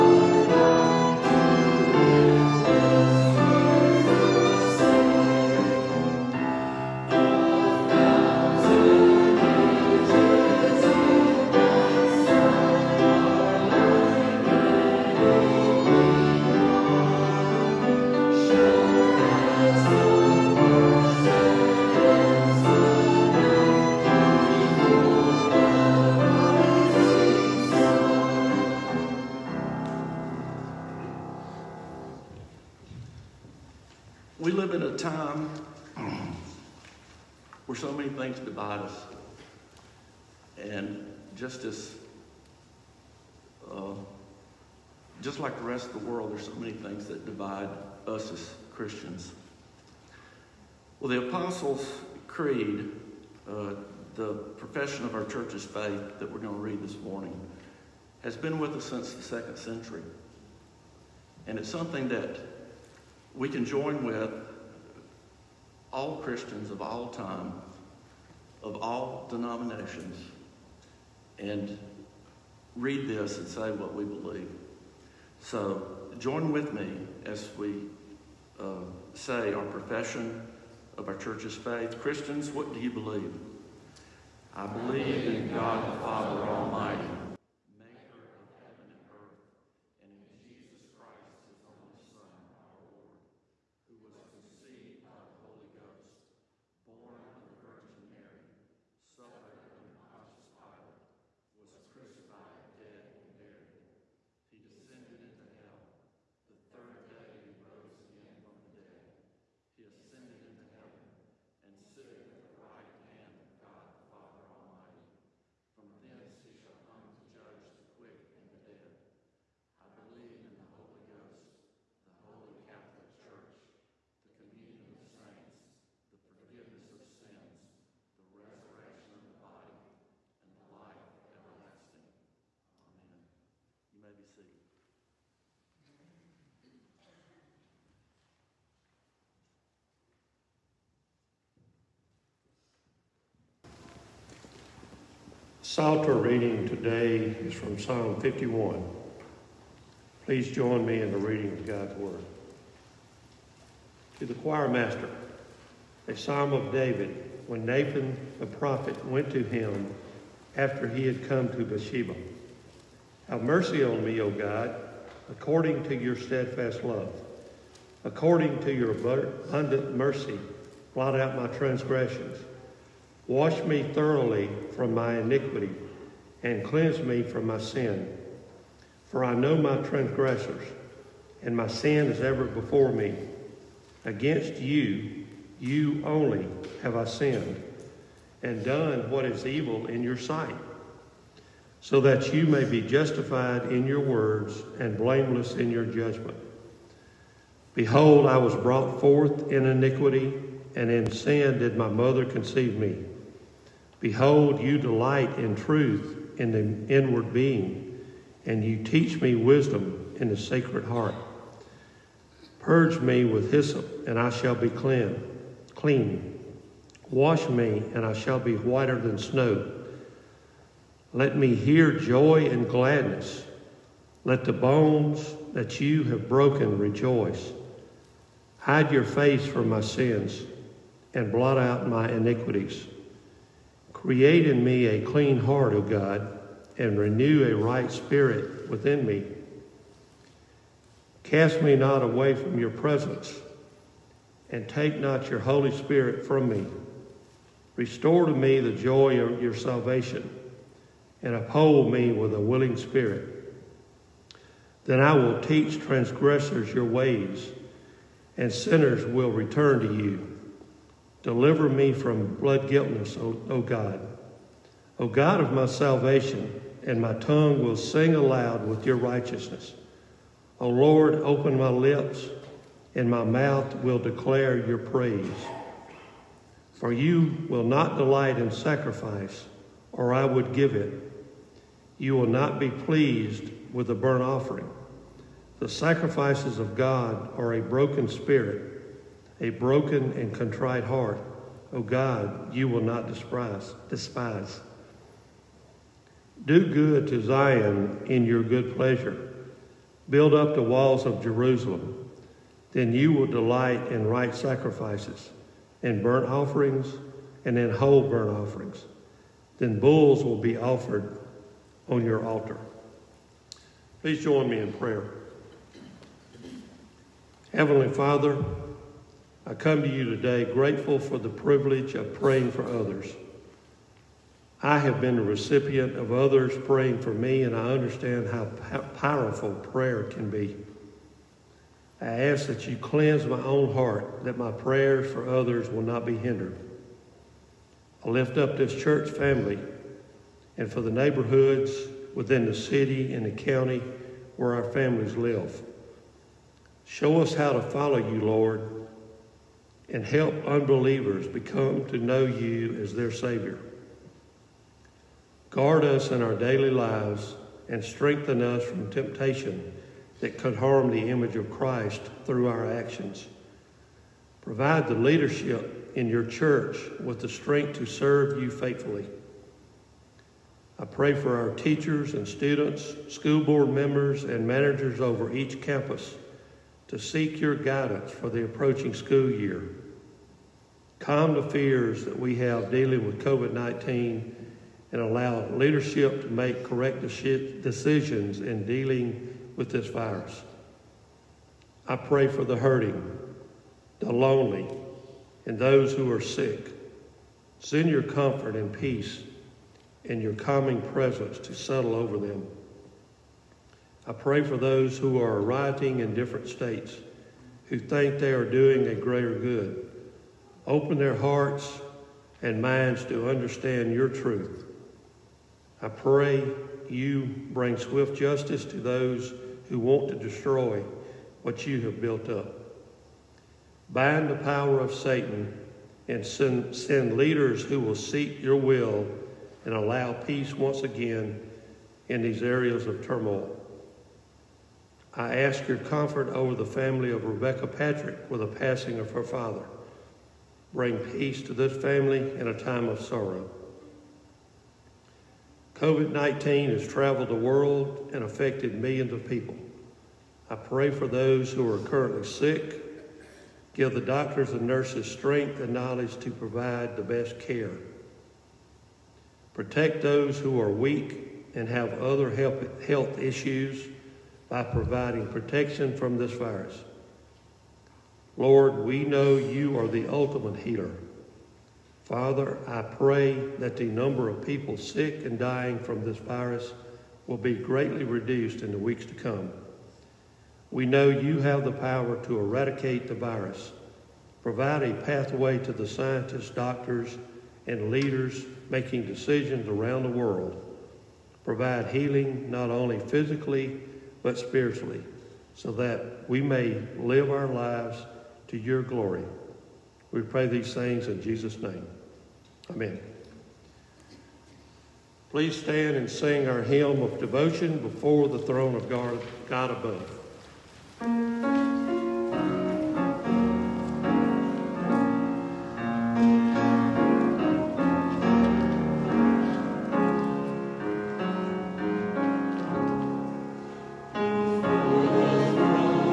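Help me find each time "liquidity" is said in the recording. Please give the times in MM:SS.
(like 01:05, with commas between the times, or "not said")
not said.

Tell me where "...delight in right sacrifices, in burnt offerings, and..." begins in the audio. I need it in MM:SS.
05:03.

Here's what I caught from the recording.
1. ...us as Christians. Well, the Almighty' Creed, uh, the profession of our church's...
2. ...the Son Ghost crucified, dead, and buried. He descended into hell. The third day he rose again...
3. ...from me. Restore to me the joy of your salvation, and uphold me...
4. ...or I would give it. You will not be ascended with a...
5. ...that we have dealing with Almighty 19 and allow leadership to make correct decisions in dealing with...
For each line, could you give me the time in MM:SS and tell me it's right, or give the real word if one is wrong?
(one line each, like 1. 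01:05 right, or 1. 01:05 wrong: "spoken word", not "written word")
1. 00:48 wrong: "Apostles", not "Almighty"
2. 01:35 wrong: "Holy", not "Son"
3. 04:06 right
4. 04:39 wrong: "pleased", not "ascended"
5. 06:22 wrong: "COVID", not "Almighty".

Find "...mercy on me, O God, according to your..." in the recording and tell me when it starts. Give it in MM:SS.
02:43.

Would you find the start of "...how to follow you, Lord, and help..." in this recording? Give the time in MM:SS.
05:47.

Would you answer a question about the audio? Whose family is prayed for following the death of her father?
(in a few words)
Rebecca Patrick.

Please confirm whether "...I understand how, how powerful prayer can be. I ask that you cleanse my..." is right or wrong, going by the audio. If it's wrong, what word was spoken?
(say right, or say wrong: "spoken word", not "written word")
right.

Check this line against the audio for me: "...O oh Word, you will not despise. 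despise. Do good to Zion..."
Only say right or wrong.
wrong.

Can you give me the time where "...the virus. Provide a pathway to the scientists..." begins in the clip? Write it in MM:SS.
08:03.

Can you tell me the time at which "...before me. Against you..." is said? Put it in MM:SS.
03:02.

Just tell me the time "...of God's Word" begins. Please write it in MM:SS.
02:31.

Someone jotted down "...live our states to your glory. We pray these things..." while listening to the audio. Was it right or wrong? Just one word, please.
wrong.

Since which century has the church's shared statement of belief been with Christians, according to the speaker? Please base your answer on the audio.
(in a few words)
second century.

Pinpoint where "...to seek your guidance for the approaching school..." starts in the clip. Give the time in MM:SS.
06:16.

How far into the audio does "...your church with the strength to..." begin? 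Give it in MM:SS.
06:06.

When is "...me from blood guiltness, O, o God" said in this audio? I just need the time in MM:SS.
04:21.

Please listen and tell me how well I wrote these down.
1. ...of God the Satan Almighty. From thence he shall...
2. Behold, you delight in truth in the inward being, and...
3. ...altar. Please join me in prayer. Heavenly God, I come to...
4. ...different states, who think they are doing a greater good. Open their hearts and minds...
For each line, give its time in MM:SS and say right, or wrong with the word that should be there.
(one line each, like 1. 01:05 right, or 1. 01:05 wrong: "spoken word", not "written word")
1. 01:53 wrong: "Father", not "Satan"
2. 03:24 right
3. 05:12 wrong: "Father", not "God"
4. 06:46 right.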